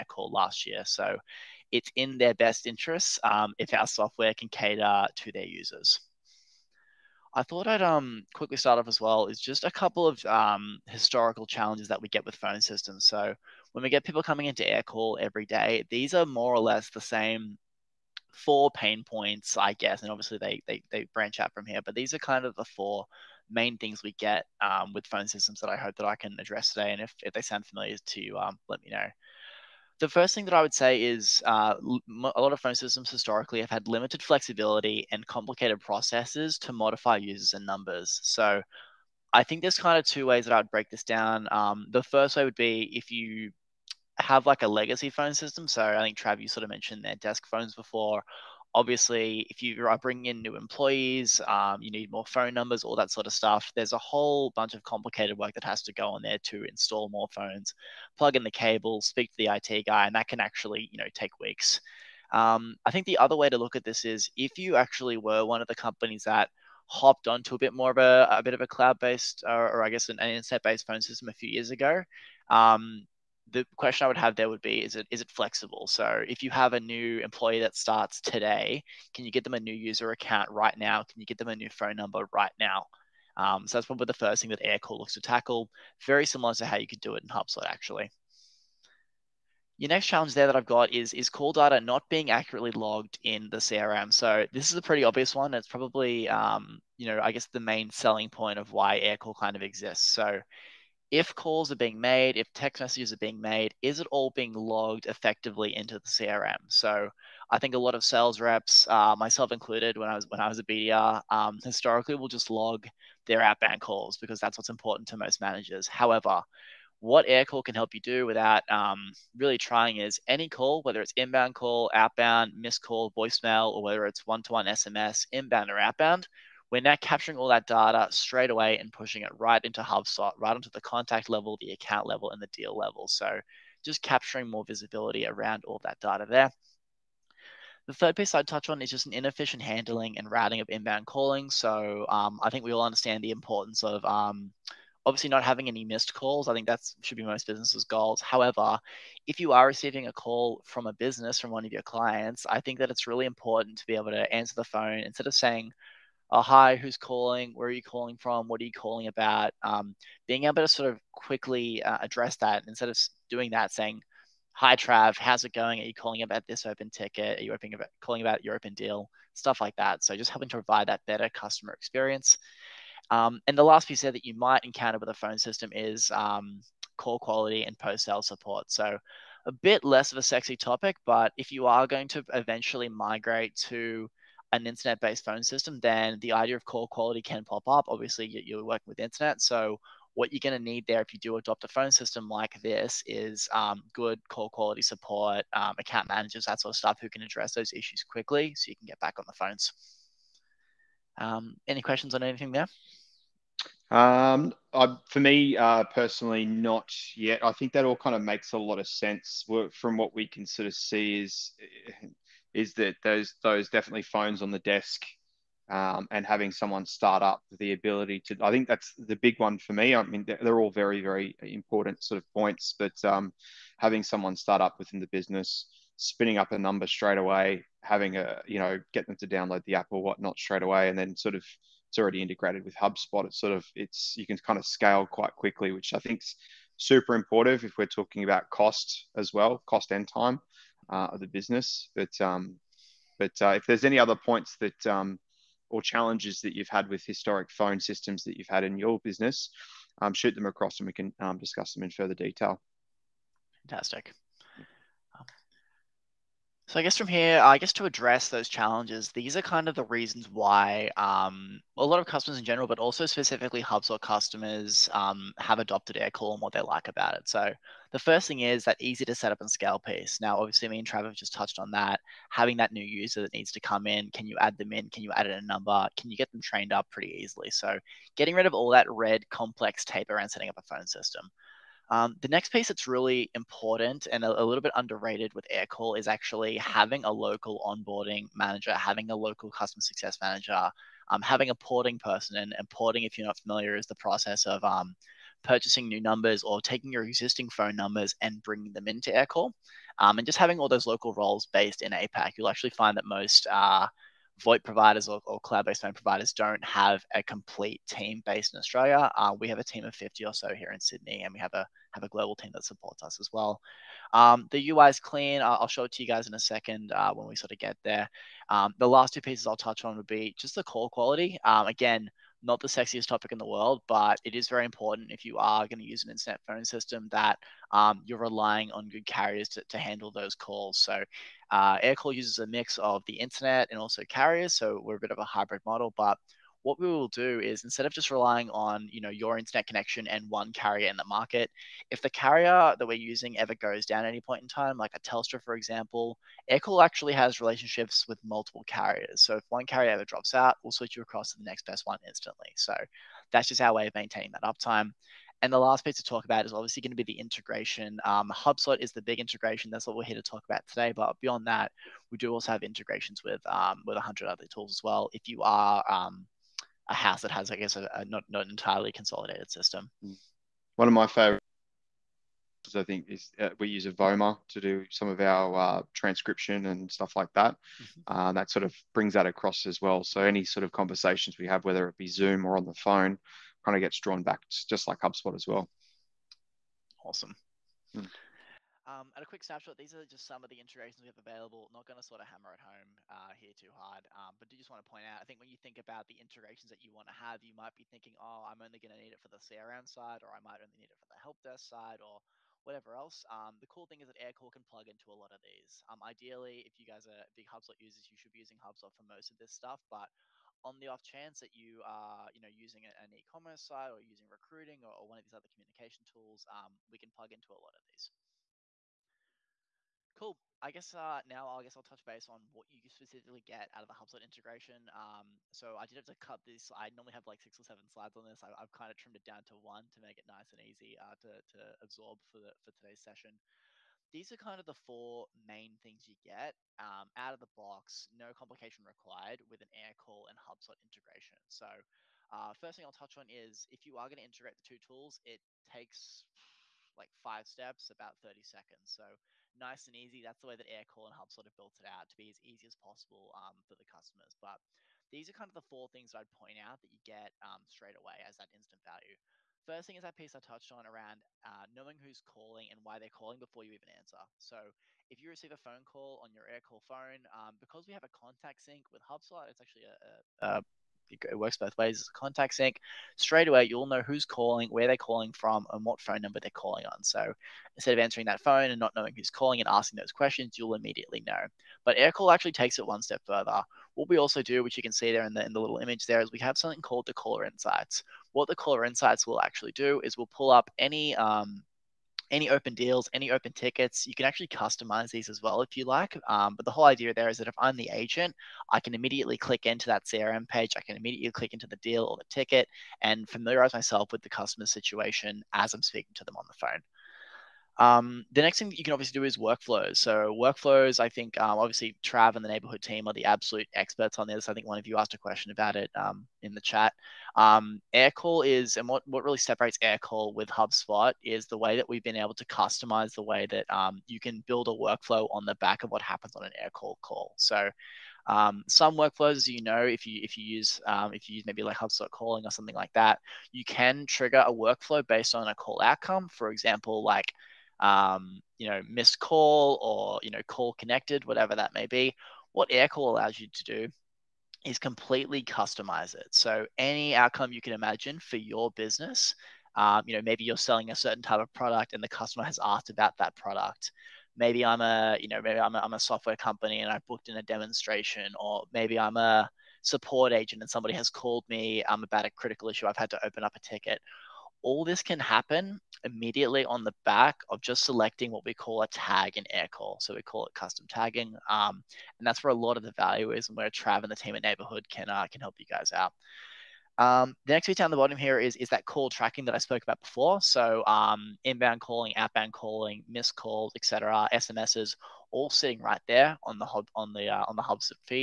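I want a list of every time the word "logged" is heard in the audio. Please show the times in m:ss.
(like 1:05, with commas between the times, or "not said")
1:32, 1:44.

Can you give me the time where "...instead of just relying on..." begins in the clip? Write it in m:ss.
5:37.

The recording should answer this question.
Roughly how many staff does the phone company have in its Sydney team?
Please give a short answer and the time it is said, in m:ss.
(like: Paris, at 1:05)
50, at 5:09.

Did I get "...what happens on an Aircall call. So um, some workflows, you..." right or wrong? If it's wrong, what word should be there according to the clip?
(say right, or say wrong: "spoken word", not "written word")
right.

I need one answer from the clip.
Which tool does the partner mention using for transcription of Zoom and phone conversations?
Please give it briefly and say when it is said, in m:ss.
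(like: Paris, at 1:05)
Avoma, at 6:13.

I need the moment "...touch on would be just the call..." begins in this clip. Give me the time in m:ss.
5:19.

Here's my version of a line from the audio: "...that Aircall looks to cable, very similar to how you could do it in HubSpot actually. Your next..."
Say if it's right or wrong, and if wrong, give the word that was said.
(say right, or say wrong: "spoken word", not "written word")
wrong: "tackle", not "cable".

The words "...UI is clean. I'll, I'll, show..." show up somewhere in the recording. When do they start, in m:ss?
5:14.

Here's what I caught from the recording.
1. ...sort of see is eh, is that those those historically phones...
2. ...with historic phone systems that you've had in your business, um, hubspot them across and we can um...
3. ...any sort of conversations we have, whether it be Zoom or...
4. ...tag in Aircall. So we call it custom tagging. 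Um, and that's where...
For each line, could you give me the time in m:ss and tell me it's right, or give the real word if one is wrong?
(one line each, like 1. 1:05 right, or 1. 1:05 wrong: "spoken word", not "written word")
1. 3:30 wrong: "definitely", not "historically"
2. 4:06 wrong: "shoot", not "hubspot"
3. 6:20 right
4. 9:28 right.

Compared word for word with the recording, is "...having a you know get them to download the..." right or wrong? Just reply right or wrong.
right.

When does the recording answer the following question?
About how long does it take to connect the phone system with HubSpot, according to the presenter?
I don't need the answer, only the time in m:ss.
7:28.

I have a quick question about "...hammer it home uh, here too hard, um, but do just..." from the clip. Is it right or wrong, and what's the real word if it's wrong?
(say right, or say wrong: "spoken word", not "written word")
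right.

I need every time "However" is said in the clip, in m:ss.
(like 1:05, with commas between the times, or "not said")
1:55, 2:28.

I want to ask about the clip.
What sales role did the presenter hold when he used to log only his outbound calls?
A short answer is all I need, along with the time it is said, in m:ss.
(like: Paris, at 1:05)
BDR, at 1:50.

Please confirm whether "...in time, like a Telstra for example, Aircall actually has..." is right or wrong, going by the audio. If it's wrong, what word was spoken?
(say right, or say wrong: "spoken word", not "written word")
right.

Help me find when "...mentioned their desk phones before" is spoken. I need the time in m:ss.
0:46.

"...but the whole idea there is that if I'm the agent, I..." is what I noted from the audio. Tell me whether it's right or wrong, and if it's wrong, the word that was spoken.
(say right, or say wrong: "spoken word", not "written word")
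right.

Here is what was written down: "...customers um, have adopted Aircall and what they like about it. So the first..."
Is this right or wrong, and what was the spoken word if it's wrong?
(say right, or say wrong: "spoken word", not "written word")
right.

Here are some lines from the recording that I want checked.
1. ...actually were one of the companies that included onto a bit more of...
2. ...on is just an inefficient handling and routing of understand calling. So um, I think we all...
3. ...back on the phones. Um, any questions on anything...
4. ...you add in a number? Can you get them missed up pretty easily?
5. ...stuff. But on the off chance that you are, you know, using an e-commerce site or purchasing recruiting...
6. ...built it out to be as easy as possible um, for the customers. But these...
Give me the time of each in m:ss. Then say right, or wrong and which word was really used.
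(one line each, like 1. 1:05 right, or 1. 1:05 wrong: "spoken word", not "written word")
1. 1:04 wrong: "hopped", not "included"
2. 2:18 wrong: "inbound", not "understand"
3. 3:18 right
4. 4:35 wrong: "trained", not "missed"
5. 6:49 wrong: "using", not "purchasing"
6. 7:31 right.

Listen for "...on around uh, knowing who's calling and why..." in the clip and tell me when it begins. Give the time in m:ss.
7:40.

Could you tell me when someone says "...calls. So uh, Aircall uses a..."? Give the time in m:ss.
5:30.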